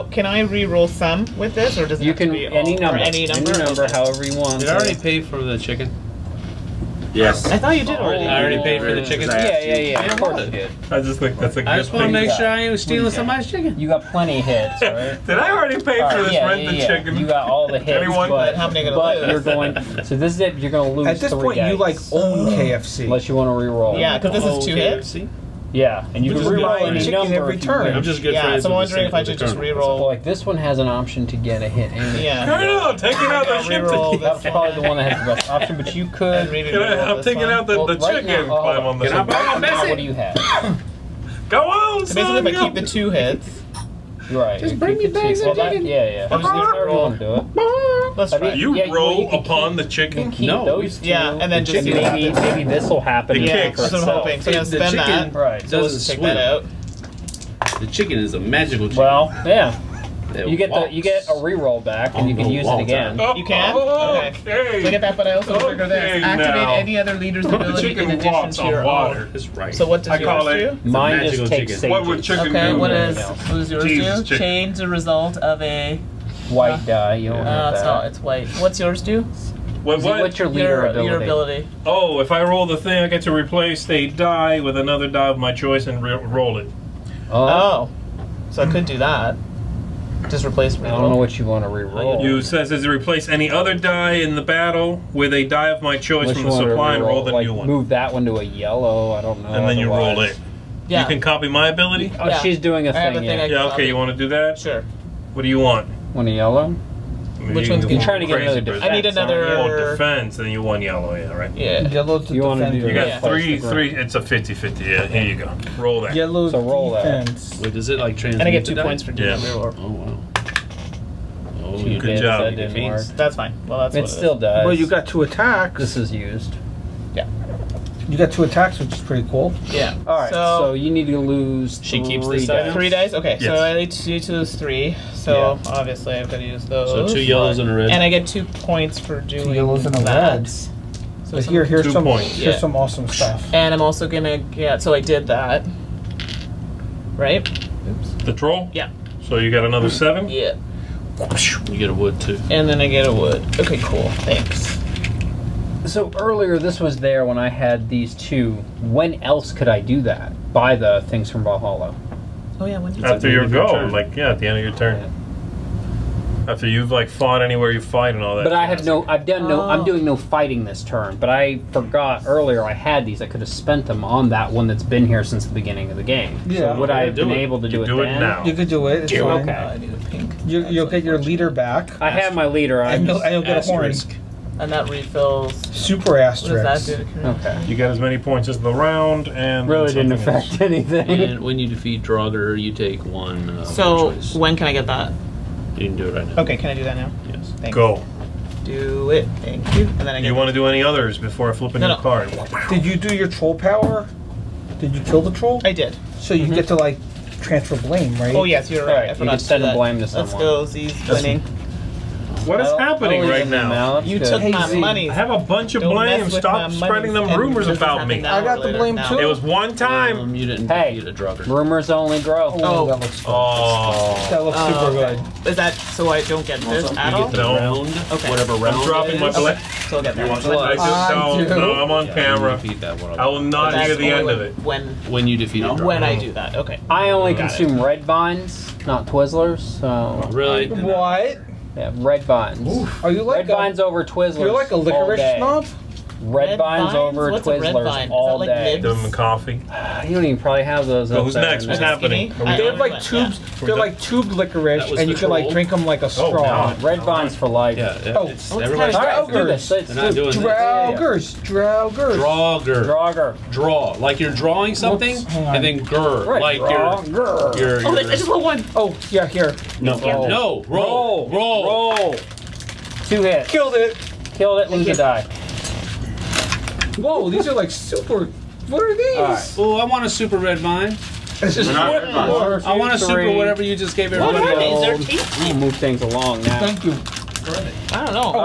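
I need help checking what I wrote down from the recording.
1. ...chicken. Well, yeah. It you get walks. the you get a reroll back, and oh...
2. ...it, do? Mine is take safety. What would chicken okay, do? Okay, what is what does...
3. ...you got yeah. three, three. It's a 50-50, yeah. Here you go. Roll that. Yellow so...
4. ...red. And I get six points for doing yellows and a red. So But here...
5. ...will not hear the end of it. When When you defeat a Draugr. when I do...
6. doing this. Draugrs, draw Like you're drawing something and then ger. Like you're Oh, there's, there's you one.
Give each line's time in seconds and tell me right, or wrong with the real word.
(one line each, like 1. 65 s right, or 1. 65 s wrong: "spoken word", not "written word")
1. 58 s right
2. 70 s right
3. 112 s right
4. 137 s wrong: "two", not "six"
5. 233 s right
6. 260 s right.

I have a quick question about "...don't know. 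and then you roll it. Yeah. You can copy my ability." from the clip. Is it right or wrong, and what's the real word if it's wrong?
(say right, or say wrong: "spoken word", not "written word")
right.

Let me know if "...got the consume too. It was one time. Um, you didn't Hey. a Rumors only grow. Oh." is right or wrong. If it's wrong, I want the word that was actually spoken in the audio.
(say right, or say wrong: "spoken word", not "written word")
wrong: "blame", not "consume".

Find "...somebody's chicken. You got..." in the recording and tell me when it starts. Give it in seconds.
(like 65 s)
13 s.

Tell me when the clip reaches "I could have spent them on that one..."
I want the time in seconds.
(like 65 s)
173 s.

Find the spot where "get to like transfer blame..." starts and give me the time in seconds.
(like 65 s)
206 s.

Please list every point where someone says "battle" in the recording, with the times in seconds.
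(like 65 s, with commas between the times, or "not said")
94 s.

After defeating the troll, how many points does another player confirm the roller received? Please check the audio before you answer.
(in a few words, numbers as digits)
7.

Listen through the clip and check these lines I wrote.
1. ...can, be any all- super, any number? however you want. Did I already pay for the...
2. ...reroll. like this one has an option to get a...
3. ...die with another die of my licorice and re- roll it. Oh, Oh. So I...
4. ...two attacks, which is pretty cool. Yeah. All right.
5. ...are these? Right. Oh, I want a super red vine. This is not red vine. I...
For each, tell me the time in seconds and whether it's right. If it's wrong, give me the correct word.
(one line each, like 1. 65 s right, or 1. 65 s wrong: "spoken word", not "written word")
1. 2 s wrong: "number", not "super"
2. 29 s right
3. 84 s wrong: "choice", not "licorice"
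4. 128 s right
5. 278 s right.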